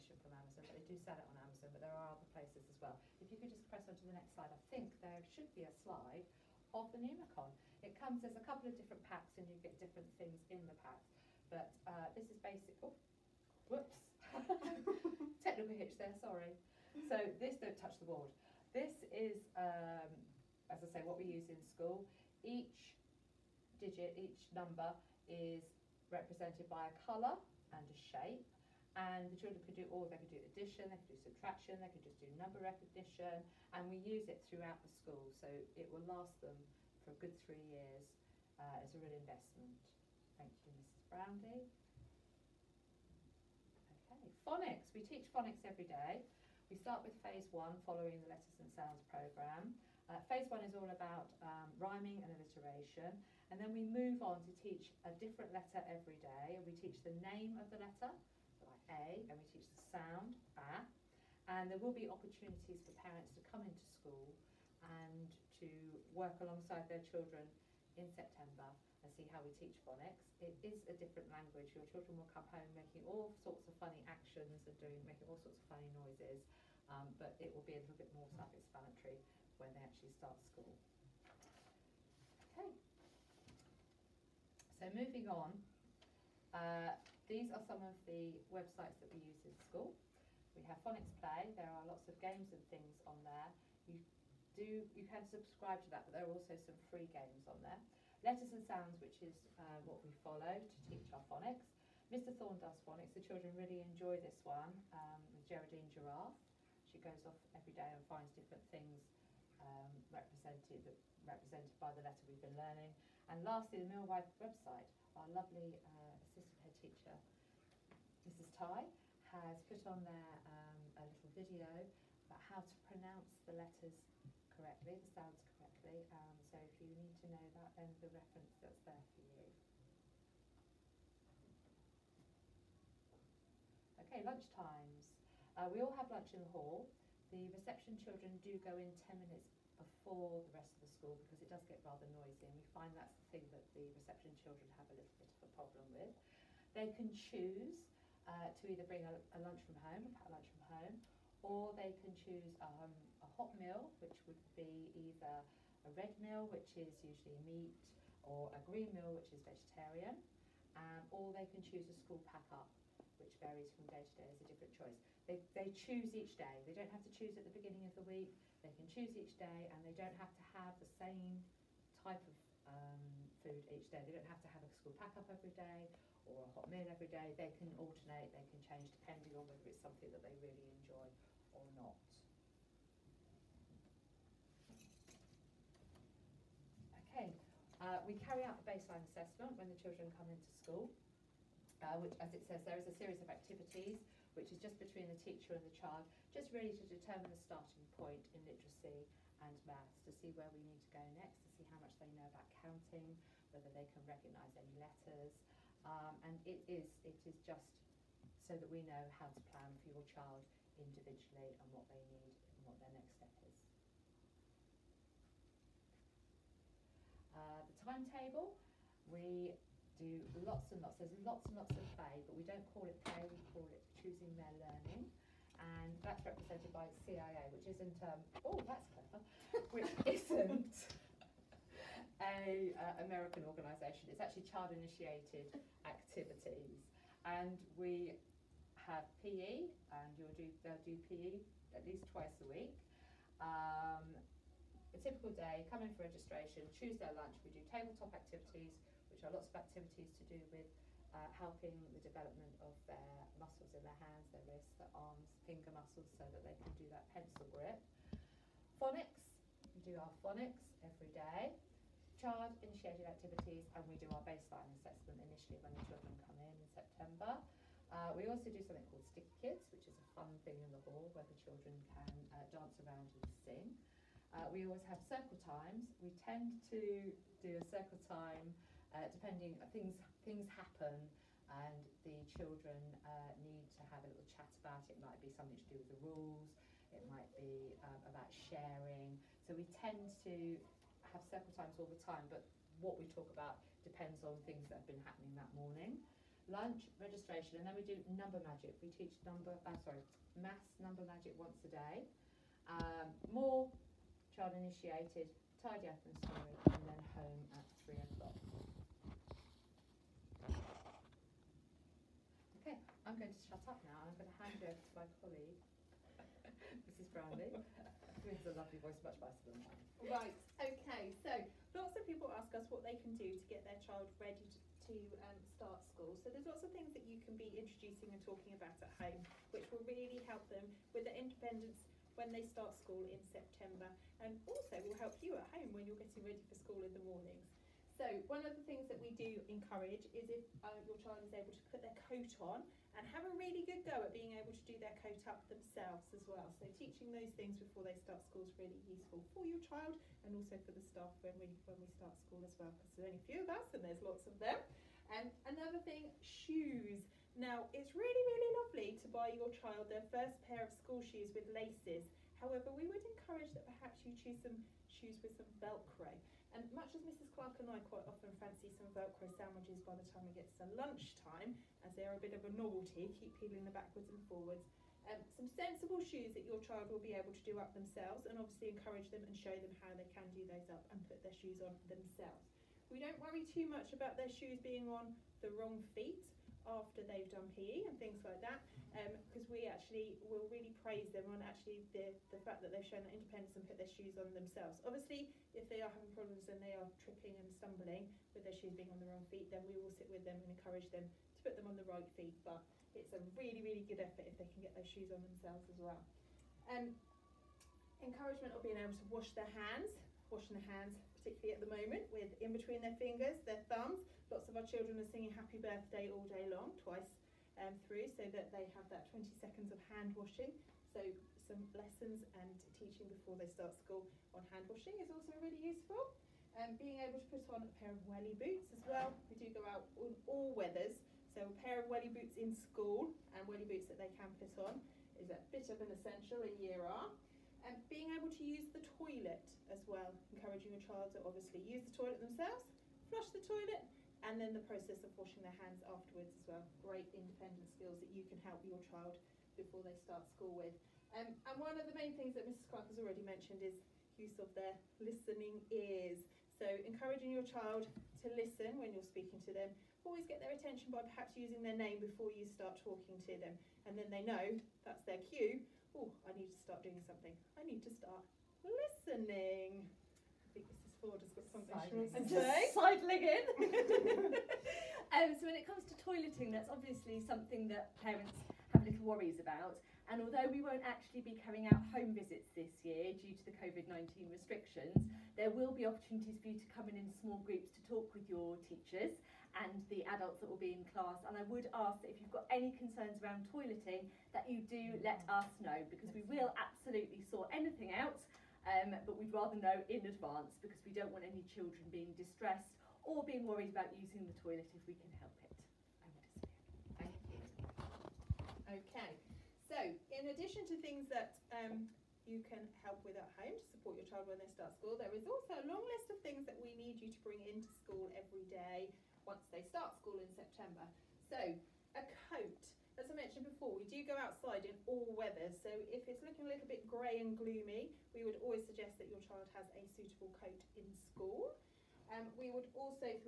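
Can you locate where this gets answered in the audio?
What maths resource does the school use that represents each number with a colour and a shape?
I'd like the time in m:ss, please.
0:07.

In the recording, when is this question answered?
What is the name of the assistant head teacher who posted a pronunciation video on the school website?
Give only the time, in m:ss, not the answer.
1:58.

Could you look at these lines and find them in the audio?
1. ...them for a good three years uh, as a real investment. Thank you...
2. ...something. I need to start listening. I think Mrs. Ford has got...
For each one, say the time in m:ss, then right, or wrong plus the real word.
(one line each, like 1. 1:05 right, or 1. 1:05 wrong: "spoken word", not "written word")
1. 0:36 right
2. 7:47 right.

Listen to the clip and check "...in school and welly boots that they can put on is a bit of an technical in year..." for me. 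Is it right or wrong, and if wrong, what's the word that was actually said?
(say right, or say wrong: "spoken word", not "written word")
wrong: "essential", not "technical".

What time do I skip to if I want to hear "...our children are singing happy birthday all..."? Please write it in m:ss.
6:54.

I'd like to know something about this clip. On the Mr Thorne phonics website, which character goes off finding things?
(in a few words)
Geraldine Giraffe.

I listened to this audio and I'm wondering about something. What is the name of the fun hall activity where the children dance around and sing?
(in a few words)
Stick Kids.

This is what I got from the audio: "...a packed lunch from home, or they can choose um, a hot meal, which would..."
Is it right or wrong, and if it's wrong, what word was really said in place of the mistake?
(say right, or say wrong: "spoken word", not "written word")
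right.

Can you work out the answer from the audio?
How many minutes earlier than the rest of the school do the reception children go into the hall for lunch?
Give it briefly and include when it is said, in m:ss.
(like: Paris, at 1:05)
10, at 2:19.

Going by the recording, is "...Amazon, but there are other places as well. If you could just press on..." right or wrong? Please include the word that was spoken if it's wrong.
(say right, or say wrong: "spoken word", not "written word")
right.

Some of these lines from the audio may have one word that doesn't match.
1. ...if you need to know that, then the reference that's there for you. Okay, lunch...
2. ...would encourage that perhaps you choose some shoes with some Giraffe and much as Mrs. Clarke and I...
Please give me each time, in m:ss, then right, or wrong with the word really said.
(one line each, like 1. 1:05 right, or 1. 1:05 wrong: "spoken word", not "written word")
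1. 2:06 right
2. 6:02 wrong: "Velcro", not "Giraffe".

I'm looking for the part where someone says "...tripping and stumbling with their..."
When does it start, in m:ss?
6:37.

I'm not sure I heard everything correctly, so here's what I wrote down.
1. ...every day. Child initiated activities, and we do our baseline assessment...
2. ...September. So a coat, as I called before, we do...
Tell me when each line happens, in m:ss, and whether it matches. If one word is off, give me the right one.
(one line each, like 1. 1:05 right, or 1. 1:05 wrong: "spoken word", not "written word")
1. 4:20 right
2. 8:40 wrong: "mentioned", not "called".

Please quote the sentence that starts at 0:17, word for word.
So this, don't touch the board.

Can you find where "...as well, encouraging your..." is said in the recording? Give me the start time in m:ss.
7:19.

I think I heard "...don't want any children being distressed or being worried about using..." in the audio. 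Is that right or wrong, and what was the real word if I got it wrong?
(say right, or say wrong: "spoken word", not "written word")
right.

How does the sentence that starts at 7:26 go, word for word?
Great independent skills that you can help your child before they start school with.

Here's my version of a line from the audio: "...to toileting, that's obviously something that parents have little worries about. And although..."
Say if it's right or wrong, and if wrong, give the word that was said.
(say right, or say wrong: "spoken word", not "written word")
right.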